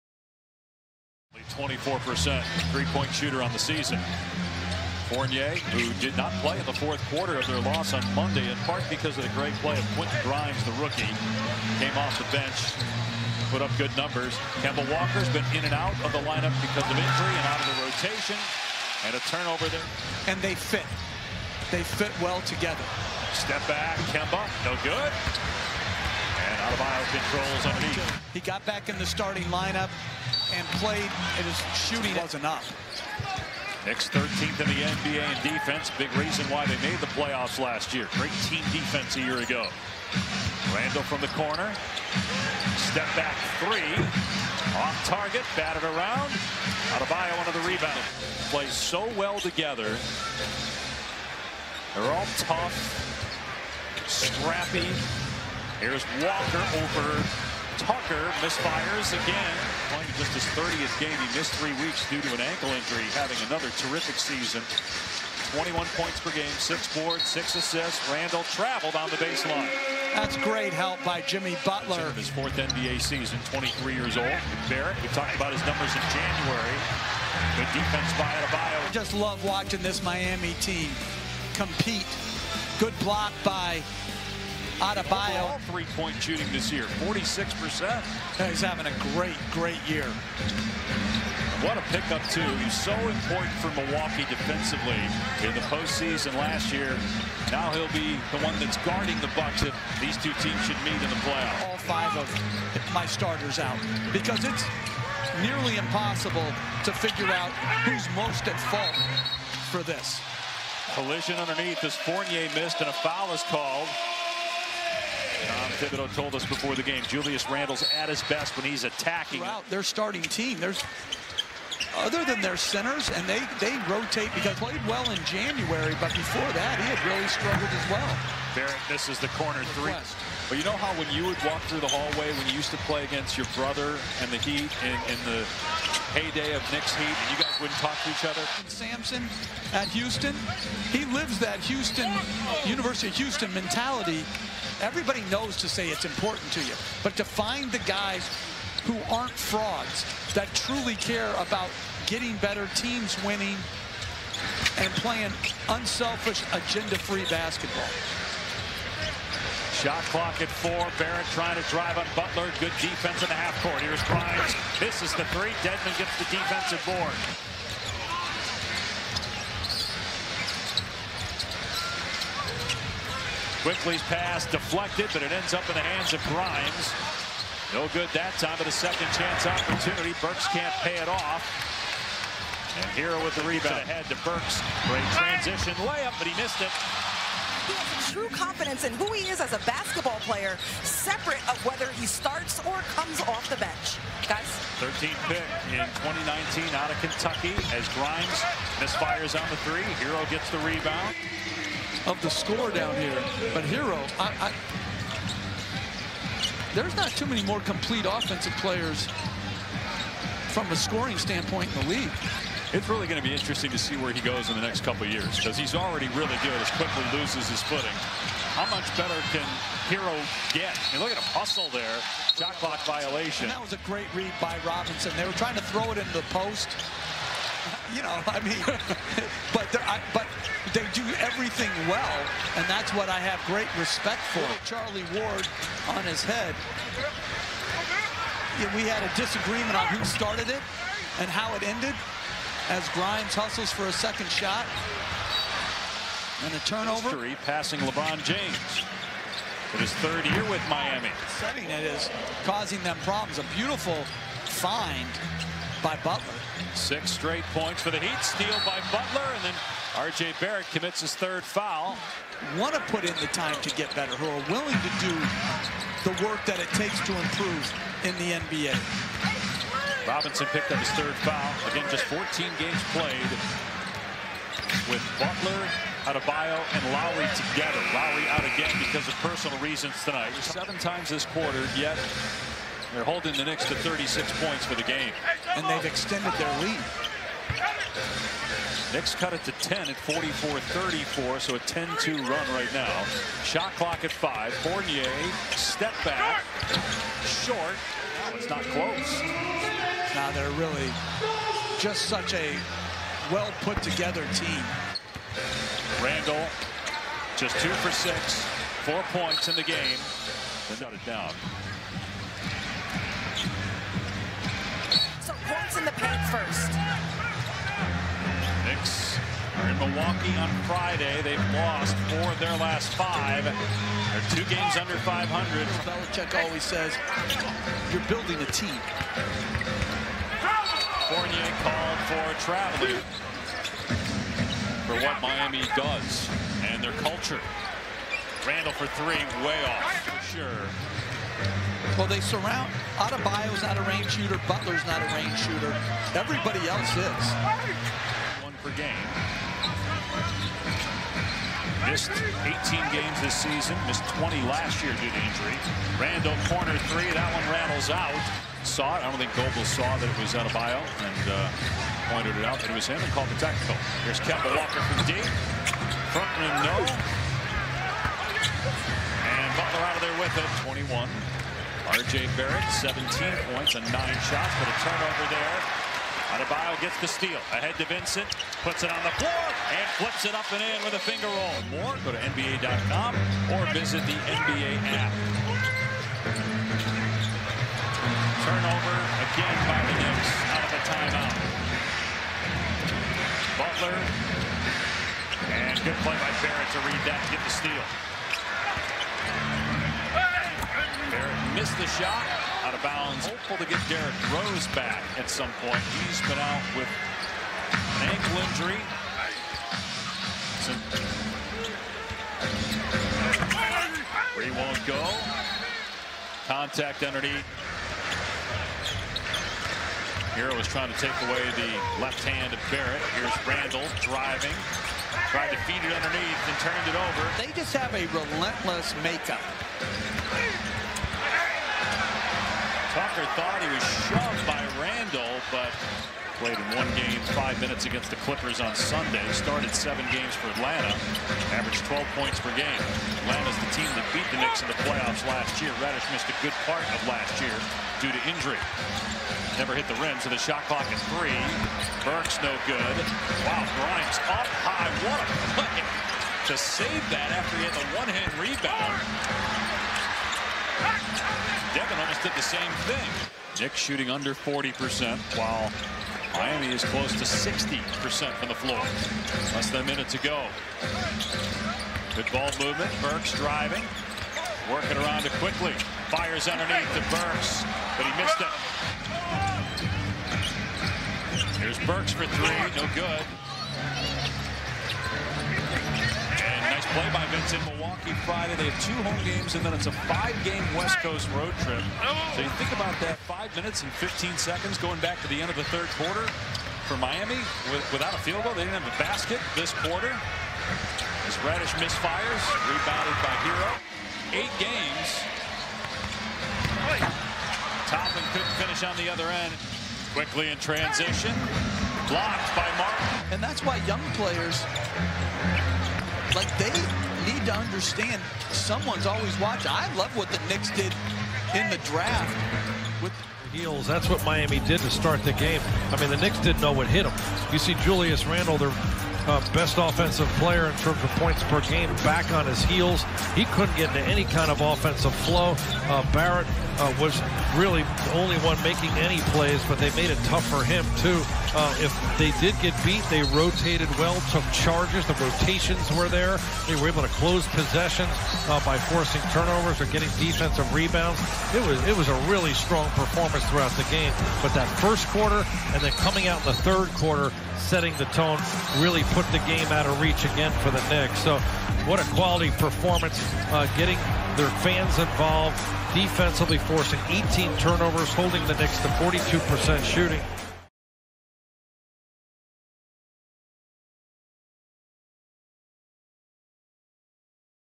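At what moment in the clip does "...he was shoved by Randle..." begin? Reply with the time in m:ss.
7:13.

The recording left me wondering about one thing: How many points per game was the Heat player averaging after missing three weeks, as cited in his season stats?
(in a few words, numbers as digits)
21.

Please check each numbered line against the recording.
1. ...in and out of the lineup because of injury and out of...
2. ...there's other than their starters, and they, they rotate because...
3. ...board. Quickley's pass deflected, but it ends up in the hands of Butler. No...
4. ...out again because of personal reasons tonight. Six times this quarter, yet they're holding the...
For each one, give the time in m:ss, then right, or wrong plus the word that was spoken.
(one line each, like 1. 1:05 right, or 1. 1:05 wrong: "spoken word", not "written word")
1. 0:15 right
2. 2:00 wrong: "centers", not "starters"
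3. 2:46 wrong: "Grimes", not "Butler"
4. 4:38 wrong: "Seven", not "Six".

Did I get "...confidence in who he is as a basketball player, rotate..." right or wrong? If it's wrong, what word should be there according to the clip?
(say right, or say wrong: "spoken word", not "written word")
wrong: "separate", not "rotate".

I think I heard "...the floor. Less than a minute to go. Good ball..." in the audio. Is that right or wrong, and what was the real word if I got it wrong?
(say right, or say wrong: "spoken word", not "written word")
right.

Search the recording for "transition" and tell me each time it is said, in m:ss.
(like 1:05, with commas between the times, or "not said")
3:05, 8:30.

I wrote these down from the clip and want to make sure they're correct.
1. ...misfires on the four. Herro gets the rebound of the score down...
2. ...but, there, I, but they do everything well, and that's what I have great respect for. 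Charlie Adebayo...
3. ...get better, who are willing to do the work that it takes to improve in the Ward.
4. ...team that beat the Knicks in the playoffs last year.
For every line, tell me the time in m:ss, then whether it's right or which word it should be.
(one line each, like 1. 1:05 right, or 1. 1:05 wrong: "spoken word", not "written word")
1. 3:18 wrong: "three", not "four"
2. 3:49 wrong: "Ward", not "Adebayo"
3. 4:23 wrong: "NBA", not "Ward"
4. 7:23 right.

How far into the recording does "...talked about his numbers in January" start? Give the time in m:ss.
1:15.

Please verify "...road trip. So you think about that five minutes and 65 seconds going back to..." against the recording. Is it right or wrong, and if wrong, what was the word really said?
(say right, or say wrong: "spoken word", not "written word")
wrong: "15", not "65".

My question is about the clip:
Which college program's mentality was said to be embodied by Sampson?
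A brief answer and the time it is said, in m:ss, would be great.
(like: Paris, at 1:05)
University of Houston, at 2:22.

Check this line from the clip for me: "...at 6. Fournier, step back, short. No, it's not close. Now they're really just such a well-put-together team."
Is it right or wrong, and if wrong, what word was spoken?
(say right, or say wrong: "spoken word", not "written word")
wrong: "5", not "6".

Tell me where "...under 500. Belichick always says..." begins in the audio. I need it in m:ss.
5:24.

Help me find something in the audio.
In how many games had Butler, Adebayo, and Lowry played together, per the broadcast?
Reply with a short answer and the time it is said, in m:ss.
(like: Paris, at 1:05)
14, at 4:32.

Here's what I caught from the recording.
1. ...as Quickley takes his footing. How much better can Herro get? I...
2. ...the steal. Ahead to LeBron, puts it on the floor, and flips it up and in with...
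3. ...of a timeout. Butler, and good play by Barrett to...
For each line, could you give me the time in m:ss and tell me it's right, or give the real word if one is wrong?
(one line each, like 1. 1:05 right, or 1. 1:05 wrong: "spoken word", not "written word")
1. 3:36 wrong: "loses", not "takes"
2. 6:17 wrong: "Vincent", not "LeBron"
3. 6:30 right.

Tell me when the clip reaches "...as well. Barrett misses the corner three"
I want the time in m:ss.
2:07.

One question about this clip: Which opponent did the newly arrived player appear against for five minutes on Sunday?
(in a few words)
Clippers.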